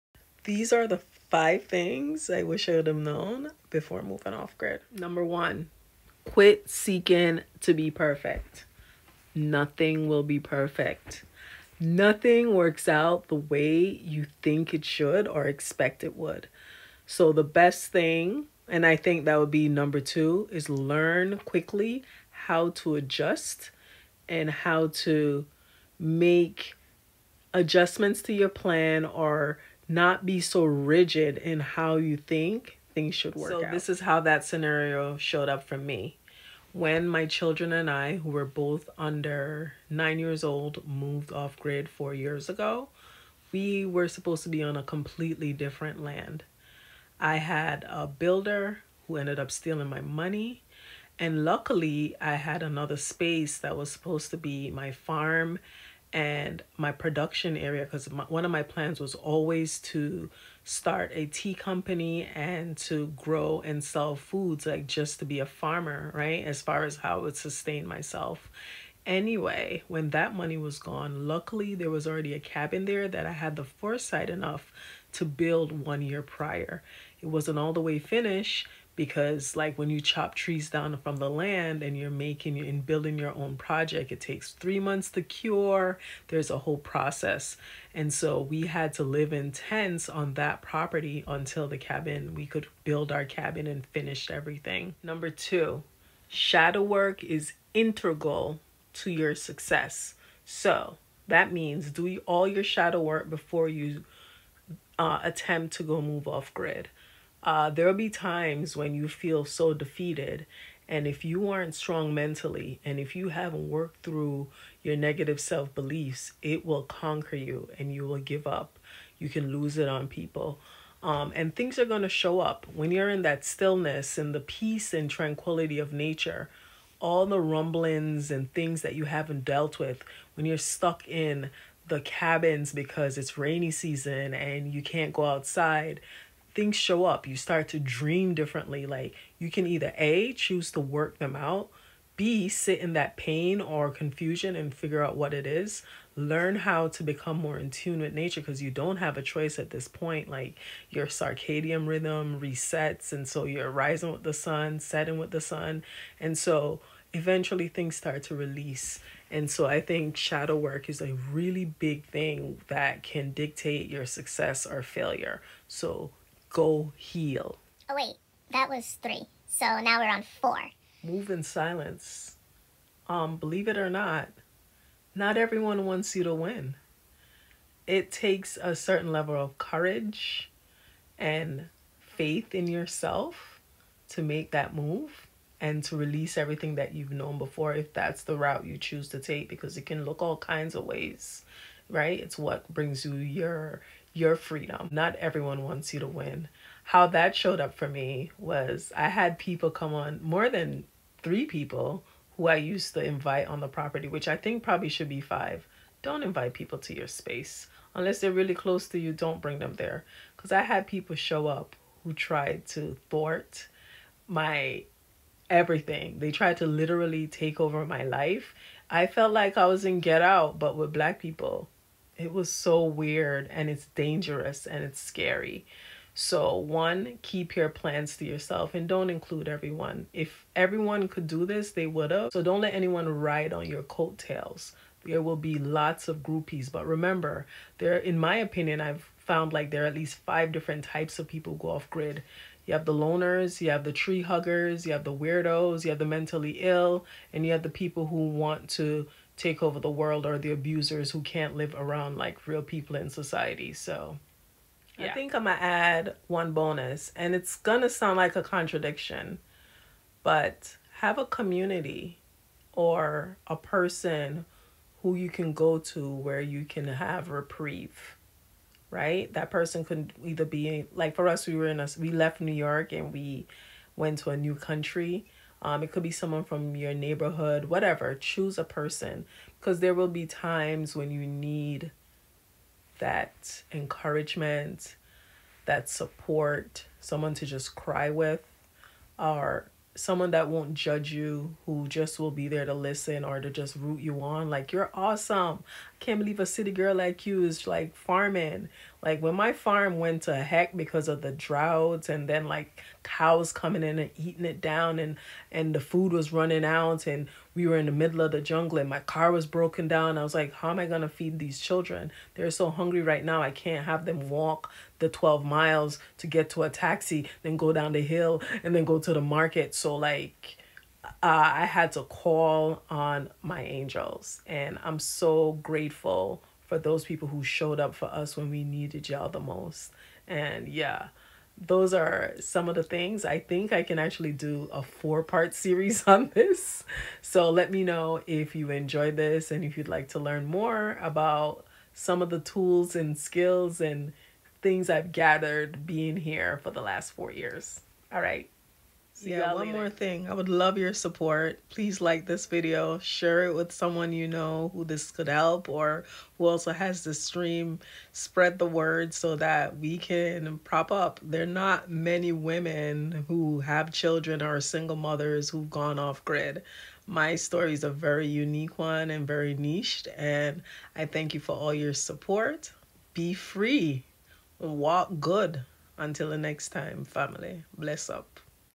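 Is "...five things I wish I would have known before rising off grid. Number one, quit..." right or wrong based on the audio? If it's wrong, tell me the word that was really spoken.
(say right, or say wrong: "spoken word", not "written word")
wrong: "moving", not "rising".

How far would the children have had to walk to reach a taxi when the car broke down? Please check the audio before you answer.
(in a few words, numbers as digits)
12 miles.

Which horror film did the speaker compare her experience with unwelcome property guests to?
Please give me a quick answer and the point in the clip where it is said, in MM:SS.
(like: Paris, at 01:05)
Get Out, at 03:39.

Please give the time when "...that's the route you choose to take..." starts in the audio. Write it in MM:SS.
03:07.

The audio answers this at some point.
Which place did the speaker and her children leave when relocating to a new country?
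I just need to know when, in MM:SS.
04:32.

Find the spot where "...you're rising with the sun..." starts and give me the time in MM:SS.
02:33.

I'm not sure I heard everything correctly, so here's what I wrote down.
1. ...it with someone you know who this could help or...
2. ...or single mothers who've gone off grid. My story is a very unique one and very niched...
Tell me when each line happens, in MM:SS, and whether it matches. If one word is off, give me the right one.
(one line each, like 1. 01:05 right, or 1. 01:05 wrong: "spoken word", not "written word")
1. 05:53 right
2. 06:04 right.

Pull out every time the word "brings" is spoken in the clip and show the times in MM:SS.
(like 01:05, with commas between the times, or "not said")
03:12, 03:29.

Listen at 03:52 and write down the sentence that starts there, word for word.
So, don't let anyone ride on your coattails.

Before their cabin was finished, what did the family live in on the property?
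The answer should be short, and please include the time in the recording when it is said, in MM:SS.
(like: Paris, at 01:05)
tents, at 01:29.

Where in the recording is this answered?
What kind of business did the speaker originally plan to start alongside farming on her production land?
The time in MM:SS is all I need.
01:01.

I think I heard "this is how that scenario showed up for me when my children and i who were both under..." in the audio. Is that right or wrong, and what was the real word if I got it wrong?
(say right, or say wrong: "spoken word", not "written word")
right.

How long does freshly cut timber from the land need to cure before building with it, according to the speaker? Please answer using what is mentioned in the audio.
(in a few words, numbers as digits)
3 months.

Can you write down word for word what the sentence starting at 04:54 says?
Like, you're awesome can't believe a city girl like you is like farming.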